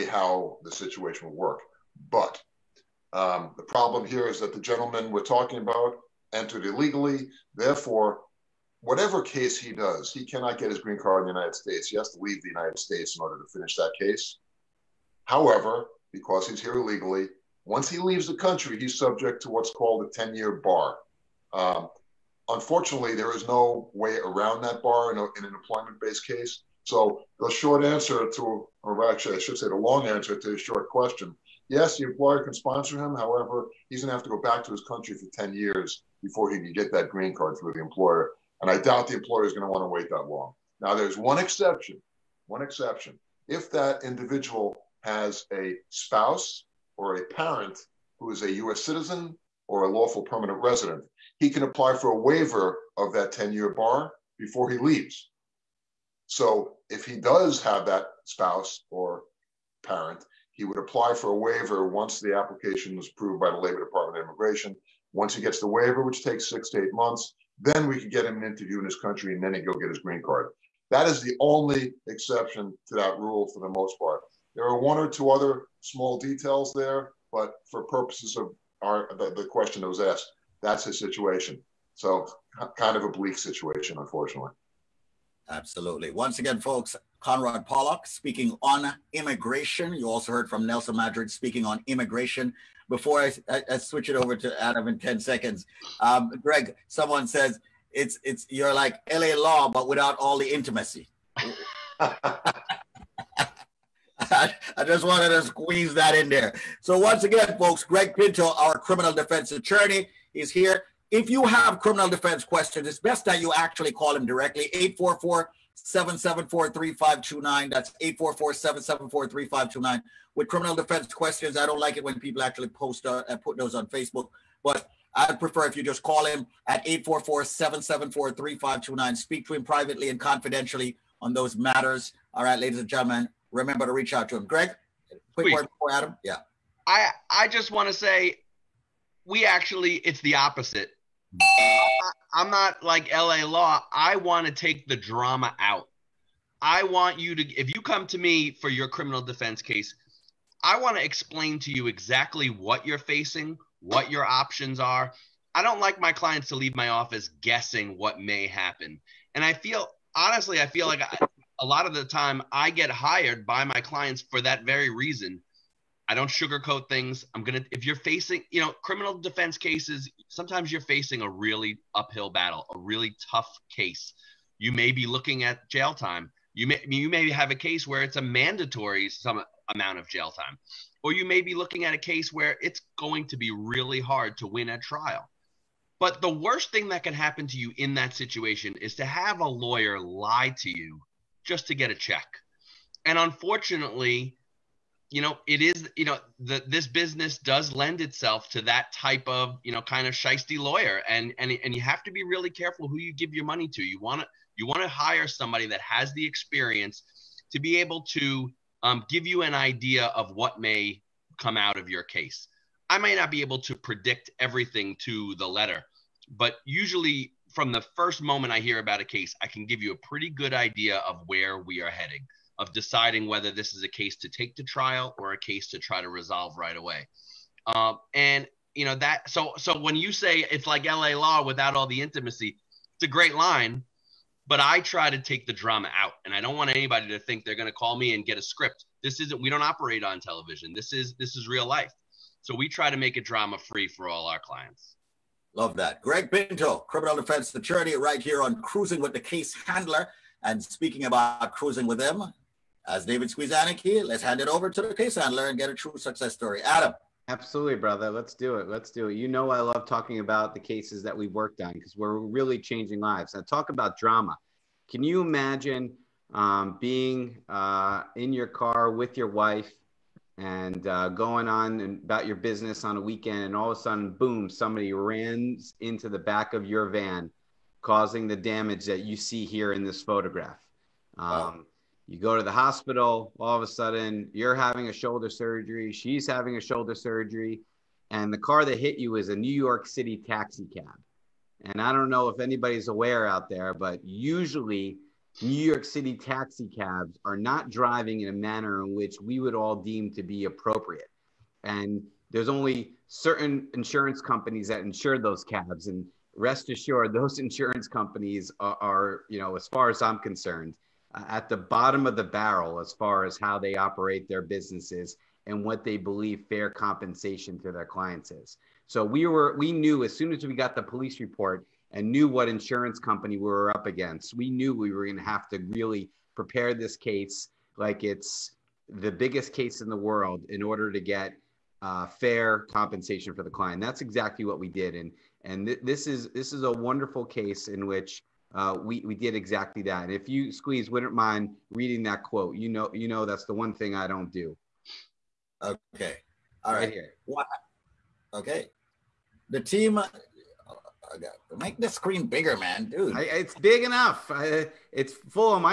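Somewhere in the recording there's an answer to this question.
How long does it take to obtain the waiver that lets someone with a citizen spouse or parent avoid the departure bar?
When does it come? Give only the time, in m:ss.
1:06.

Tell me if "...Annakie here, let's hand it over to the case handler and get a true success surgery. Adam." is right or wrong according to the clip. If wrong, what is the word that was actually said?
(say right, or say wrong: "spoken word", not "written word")
wrong: "story", not "surgery".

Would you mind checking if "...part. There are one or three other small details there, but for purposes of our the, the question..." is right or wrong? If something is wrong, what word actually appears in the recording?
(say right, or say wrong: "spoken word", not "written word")
wrong: "two", not "three".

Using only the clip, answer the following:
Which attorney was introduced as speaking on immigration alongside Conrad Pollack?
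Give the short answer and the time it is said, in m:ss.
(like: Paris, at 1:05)
Nelson Madrid, at 1:30.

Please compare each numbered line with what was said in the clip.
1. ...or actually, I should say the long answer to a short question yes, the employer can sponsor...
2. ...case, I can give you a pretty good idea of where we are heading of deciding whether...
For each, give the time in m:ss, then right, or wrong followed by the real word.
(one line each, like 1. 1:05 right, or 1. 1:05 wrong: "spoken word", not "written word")
1. 0:28 right
2. 3:39 right.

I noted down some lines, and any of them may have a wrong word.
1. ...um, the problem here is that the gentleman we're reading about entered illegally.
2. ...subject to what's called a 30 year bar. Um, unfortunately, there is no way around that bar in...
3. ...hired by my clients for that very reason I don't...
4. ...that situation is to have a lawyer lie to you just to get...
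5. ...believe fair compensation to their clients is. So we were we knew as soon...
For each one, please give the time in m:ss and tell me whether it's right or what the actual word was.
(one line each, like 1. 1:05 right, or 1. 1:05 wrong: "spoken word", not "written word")
1. 0:03 wrong: "talking", not "reading"
2. 0:18 wrong: "10", not "30"
3. 2:42 right
4. 3:07 right
5. 5:15 right.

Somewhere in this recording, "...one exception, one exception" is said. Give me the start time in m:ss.
0:41.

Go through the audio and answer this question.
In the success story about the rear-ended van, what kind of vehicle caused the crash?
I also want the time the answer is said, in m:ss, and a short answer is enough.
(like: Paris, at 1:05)
New York City taxi cab, at 4:49.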